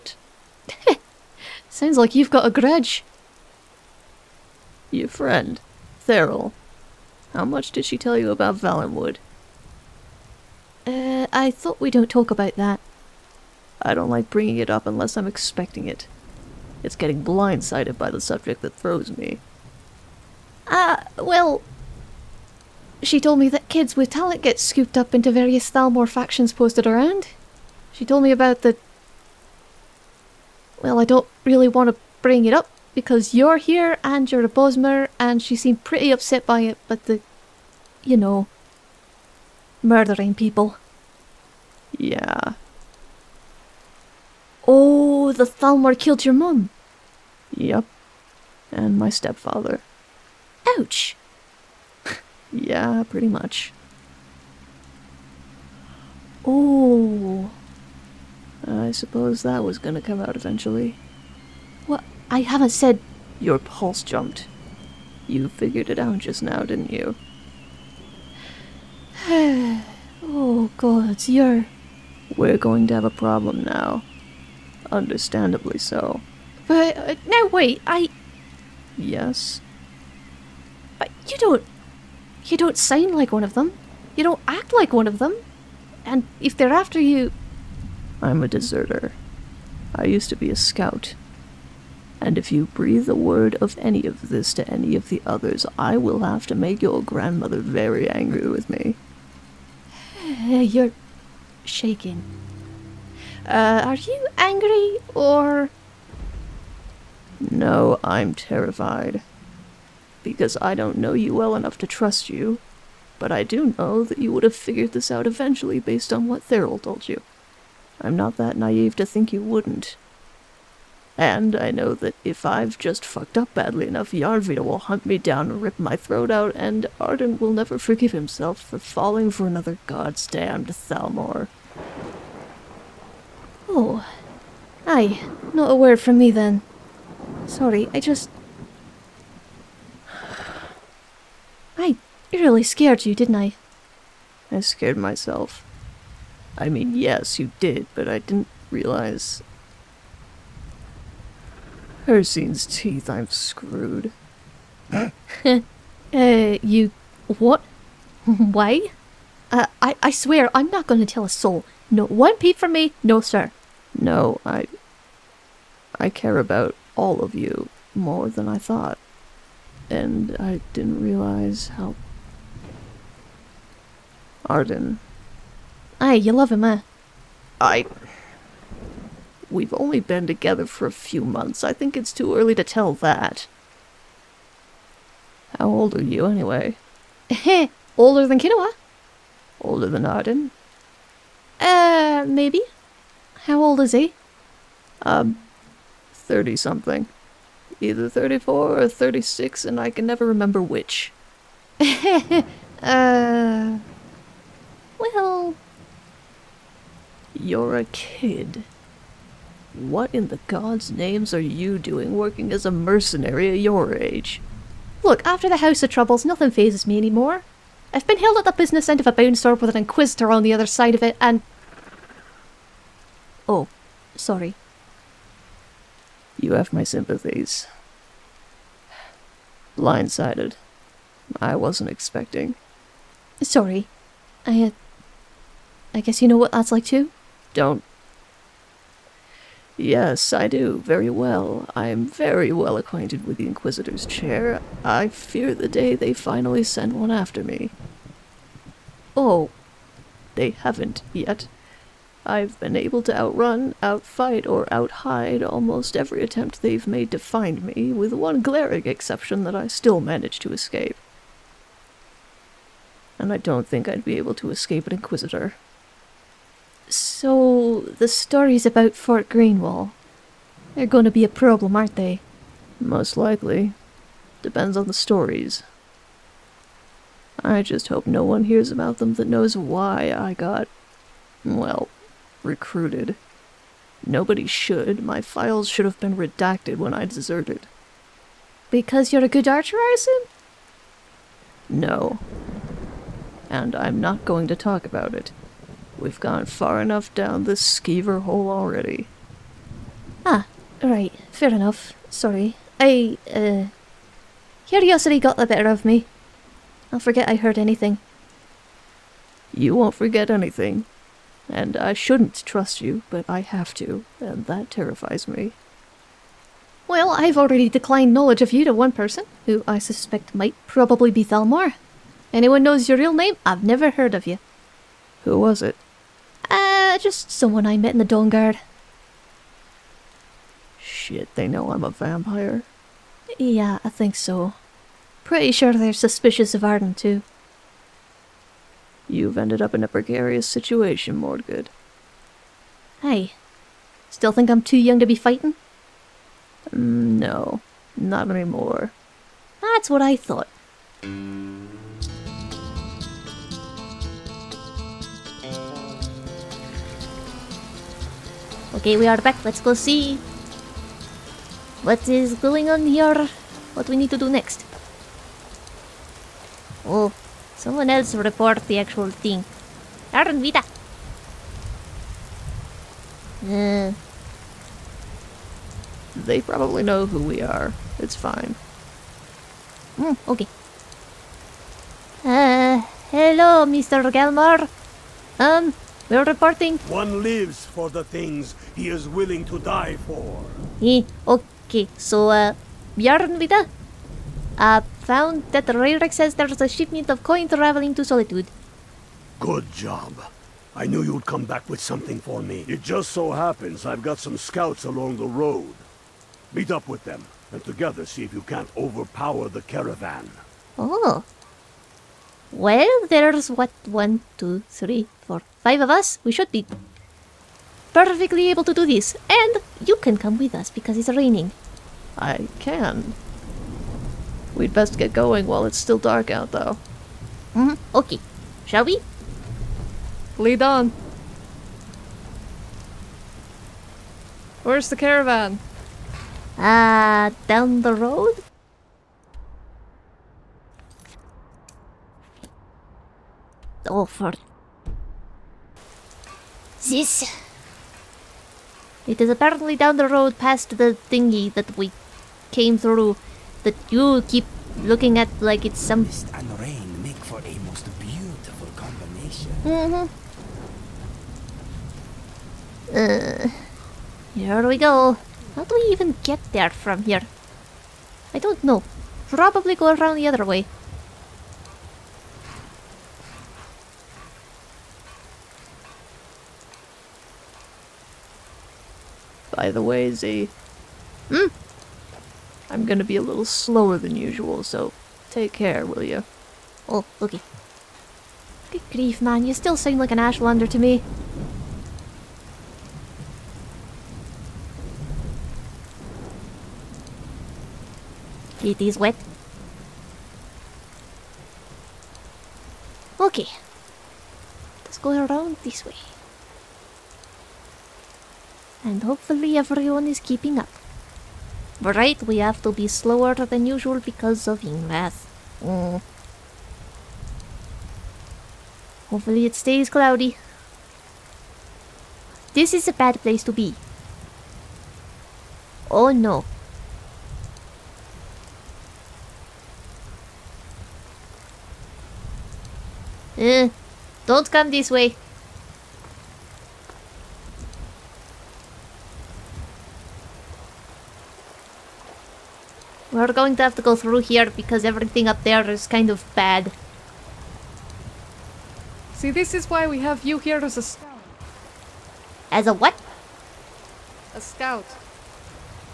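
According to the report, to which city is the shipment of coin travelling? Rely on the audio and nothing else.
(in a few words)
Solitude.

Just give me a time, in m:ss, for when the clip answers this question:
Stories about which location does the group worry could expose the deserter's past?
4:28.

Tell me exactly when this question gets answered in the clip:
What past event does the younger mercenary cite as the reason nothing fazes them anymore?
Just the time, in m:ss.
3:35.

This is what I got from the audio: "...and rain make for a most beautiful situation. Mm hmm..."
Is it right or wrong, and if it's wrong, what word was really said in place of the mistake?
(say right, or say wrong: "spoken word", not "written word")
wrong: "combination", not "situation".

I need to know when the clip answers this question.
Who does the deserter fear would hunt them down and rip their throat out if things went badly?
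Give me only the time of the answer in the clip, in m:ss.
2:04.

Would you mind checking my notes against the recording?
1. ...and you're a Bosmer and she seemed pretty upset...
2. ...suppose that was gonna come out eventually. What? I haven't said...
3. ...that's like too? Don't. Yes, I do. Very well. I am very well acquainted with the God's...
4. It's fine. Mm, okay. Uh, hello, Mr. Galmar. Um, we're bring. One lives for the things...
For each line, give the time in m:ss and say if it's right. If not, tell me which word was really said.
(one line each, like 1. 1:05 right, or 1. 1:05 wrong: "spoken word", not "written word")
1. 0:34 right
2. 0:58 right
3. 3:56 wrong: "Inquisitor", not "God"
4. 6:17 wrong: "reporting", not "bring".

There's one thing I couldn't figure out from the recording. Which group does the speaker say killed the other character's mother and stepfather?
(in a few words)
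The Thalmor.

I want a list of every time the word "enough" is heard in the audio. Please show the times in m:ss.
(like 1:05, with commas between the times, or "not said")
1:51, 2:03, 4:56, 5:01.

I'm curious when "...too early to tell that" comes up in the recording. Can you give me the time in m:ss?
3:02.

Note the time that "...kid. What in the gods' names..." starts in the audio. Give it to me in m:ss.
3:27.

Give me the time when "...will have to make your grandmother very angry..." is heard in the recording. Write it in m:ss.
1:35.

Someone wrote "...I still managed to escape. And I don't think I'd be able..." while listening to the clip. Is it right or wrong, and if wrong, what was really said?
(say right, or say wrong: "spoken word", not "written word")
right.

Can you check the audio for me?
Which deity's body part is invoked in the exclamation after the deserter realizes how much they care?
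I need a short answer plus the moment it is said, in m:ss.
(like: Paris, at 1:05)
Hircine, at 2:32.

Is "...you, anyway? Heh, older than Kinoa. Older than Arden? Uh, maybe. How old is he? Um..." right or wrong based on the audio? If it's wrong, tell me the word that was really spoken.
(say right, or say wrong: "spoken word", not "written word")
right.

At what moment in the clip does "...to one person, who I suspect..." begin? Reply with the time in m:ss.
5:18.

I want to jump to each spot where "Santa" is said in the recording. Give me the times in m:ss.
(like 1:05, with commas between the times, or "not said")
not said.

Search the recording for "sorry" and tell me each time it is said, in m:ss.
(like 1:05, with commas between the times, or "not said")
2:17, 3:44, 3:53, 5:02.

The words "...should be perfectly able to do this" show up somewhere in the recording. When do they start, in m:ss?
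6:56.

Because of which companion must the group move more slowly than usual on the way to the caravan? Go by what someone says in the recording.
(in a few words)
Ingrath.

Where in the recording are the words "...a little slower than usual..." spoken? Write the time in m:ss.
8:03.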